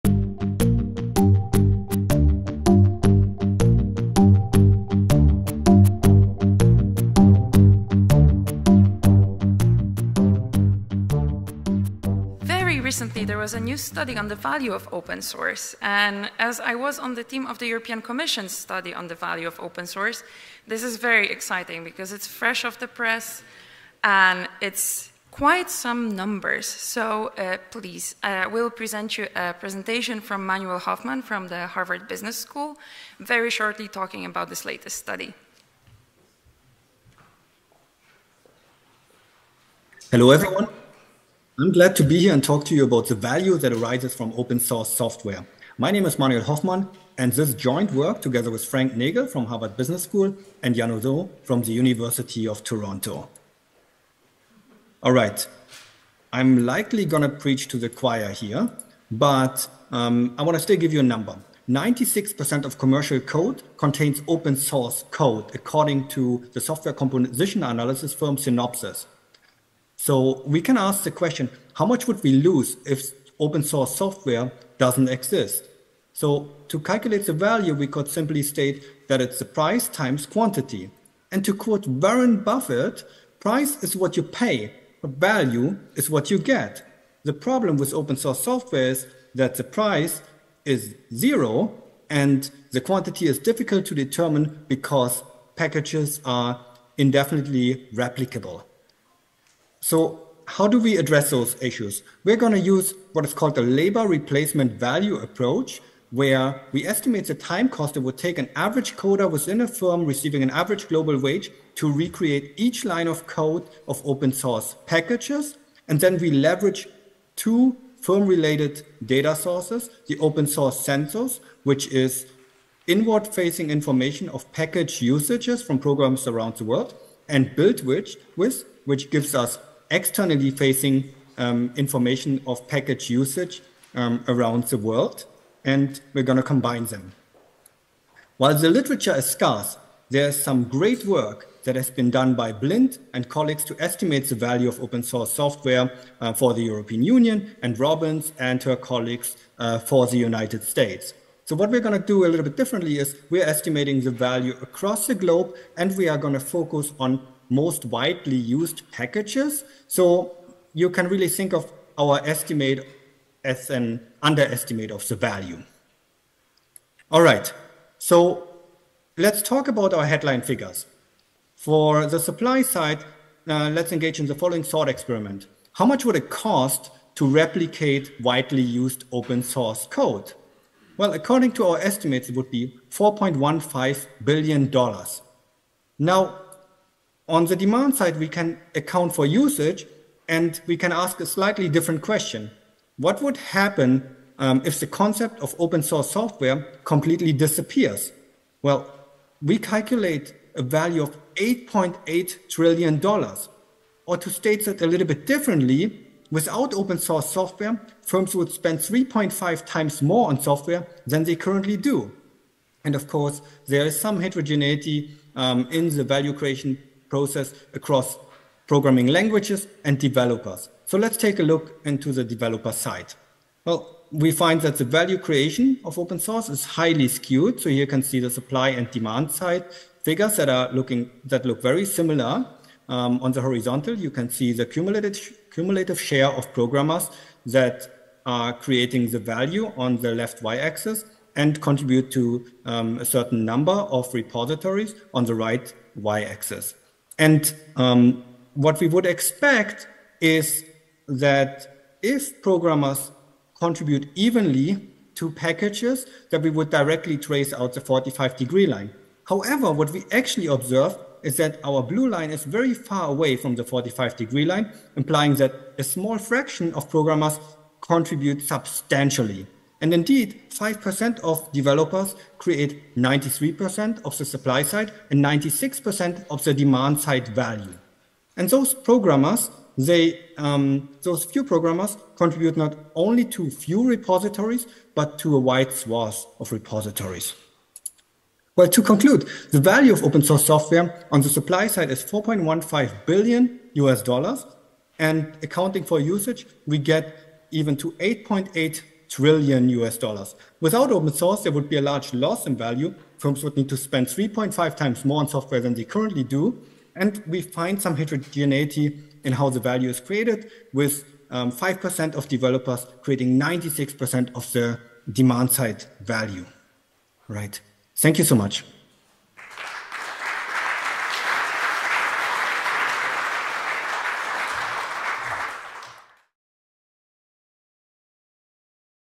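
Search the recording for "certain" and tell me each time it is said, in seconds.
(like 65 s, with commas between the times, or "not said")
243 s.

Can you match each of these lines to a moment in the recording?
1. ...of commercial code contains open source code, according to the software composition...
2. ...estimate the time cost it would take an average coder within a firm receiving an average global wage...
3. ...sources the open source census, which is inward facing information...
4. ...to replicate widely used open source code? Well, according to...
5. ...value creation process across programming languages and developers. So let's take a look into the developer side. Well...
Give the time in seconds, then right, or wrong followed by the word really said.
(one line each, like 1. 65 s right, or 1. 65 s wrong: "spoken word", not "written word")
1. 62 s right
2. 106 s right
3. 119 s right
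4. 177 s right
5. 216 s right.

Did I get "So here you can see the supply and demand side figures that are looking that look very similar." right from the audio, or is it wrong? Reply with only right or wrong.
right.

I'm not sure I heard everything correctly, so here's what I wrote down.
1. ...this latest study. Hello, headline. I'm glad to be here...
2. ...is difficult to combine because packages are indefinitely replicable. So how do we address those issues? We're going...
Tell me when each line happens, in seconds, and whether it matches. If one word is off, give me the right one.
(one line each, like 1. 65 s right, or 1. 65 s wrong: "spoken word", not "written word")
1. 34 s wrong: "everyone", not "headline"
2. 93 s wrong: "determine", not "combine".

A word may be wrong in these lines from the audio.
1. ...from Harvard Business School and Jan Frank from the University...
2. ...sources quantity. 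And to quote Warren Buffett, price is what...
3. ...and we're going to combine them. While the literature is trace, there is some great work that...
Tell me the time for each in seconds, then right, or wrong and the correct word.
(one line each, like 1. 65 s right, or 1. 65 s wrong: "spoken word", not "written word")
1. 49 s wrong: "Odo", not "Frank"
2. 79 s wrong: "times", not "sources"
3. 135 s wrong: "scarce", not "trace".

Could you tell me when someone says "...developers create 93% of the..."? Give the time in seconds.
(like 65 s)
271 s.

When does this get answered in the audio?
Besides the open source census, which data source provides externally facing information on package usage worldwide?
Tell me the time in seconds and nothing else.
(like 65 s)
127 s.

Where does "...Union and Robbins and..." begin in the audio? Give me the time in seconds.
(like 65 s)
147 s.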